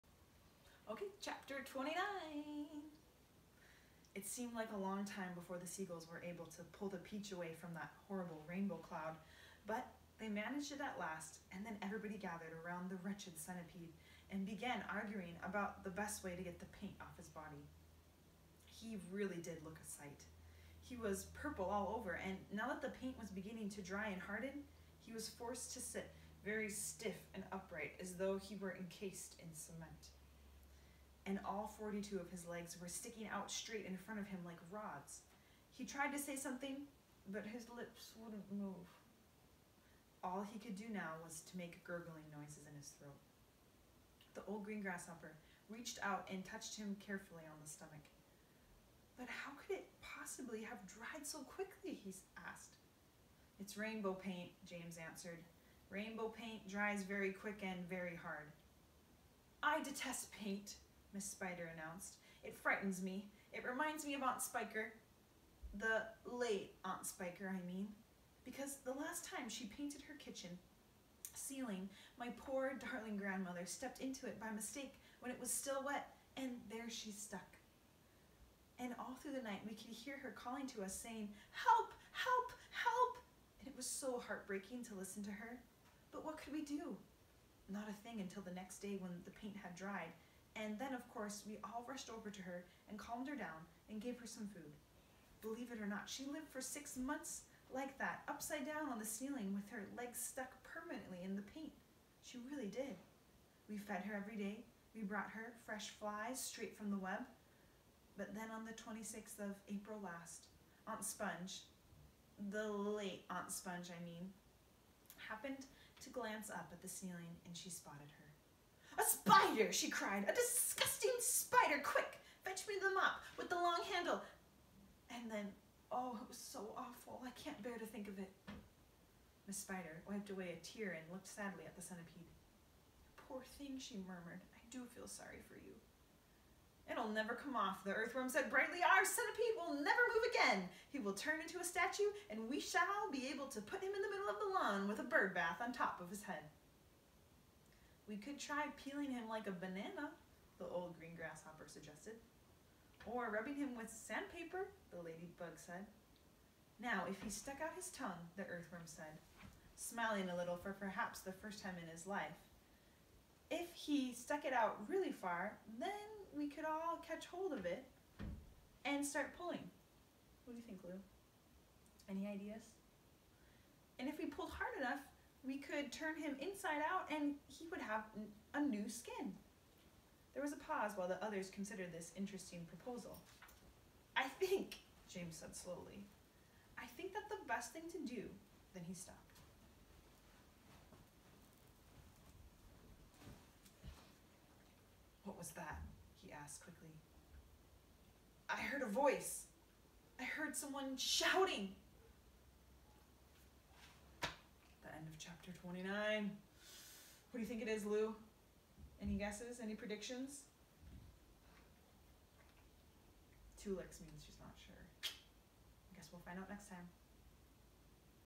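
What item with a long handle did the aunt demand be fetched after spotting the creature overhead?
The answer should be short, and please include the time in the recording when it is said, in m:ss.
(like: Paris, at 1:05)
the mop, at 2:02.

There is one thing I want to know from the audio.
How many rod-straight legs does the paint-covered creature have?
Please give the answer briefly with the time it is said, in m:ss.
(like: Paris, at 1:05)
42, at 0:31.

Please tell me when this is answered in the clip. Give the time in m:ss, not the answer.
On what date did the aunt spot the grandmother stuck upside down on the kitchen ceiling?
1:48.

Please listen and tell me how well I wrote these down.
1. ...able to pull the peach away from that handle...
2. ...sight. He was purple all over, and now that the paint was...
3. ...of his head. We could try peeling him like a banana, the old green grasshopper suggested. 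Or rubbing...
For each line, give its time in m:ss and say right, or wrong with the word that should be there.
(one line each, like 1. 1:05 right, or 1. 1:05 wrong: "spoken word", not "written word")
1. 0:06 wrong: "horrible", not "handle"
2. 0:19 right
3. 2:26 right.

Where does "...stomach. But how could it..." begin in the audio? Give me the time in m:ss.
0:47.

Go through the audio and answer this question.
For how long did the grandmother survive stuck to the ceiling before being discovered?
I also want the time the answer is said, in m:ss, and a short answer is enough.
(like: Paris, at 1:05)
six months, at 1:36.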